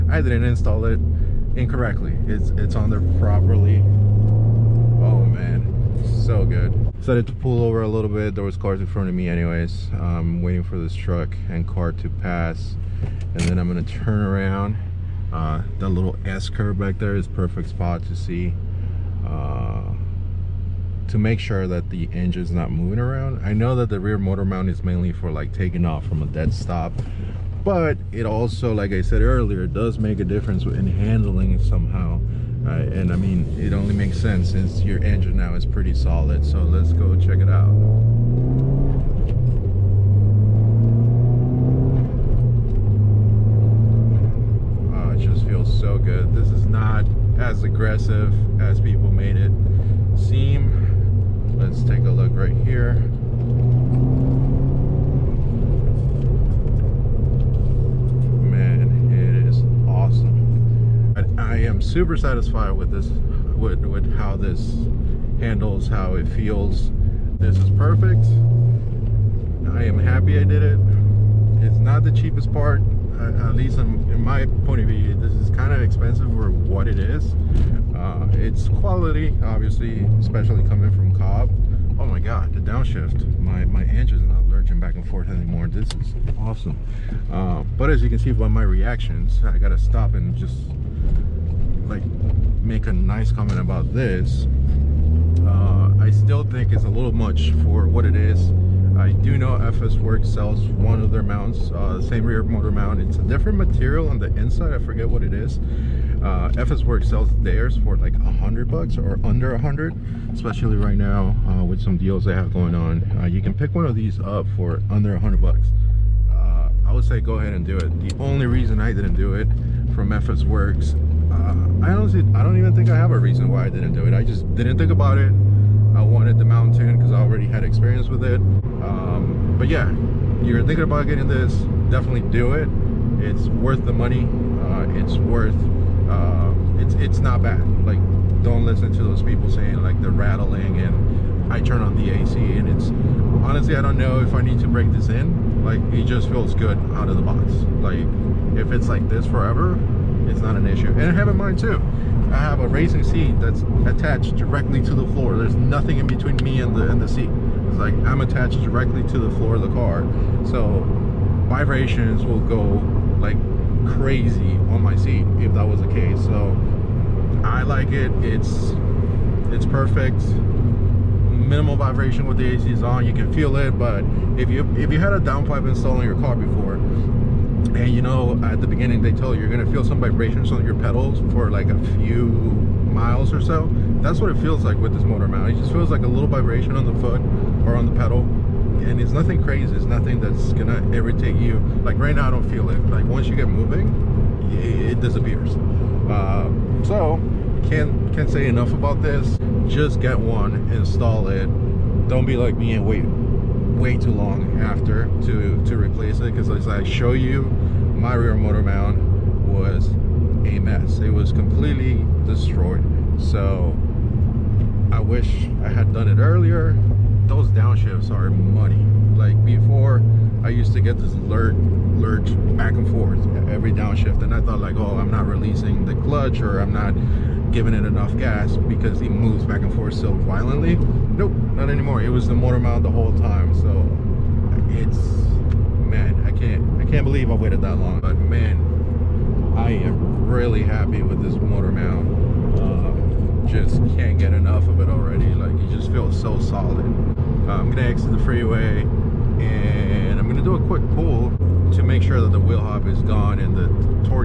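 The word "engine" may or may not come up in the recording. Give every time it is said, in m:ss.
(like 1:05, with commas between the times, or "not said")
0:22, 0:35.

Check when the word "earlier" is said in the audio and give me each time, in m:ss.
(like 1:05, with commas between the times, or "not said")
0:29, 3:36.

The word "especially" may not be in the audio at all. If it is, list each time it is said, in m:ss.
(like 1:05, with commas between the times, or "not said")
1:20, 1:50.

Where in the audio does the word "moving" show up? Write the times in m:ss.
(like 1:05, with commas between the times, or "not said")
0:22, 3:13.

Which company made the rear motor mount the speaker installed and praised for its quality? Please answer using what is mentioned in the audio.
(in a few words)
Cobb.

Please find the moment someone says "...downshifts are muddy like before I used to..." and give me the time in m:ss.
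3:37.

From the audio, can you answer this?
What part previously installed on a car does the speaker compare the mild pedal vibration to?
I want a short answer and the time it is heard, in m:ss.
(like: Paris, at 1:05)
downpipe, at 2:55.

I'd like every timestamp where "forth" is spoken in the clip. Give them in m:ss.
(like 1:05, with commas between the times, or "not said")
1:25, 3:42, 3:49.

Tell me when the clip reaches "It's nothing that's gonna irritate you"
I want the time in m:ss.
3:09.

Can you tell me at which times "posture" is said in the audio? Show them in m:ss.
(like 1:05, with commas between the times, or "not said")
not said.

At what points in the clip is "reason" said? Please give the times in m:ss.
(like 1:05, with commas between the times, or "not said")
1:58, 2:03.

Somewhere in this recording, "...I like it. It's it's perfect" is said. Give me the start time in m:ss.
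2:47.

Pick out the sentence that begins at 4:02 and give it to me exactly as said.
Um, just can't get enough of it already.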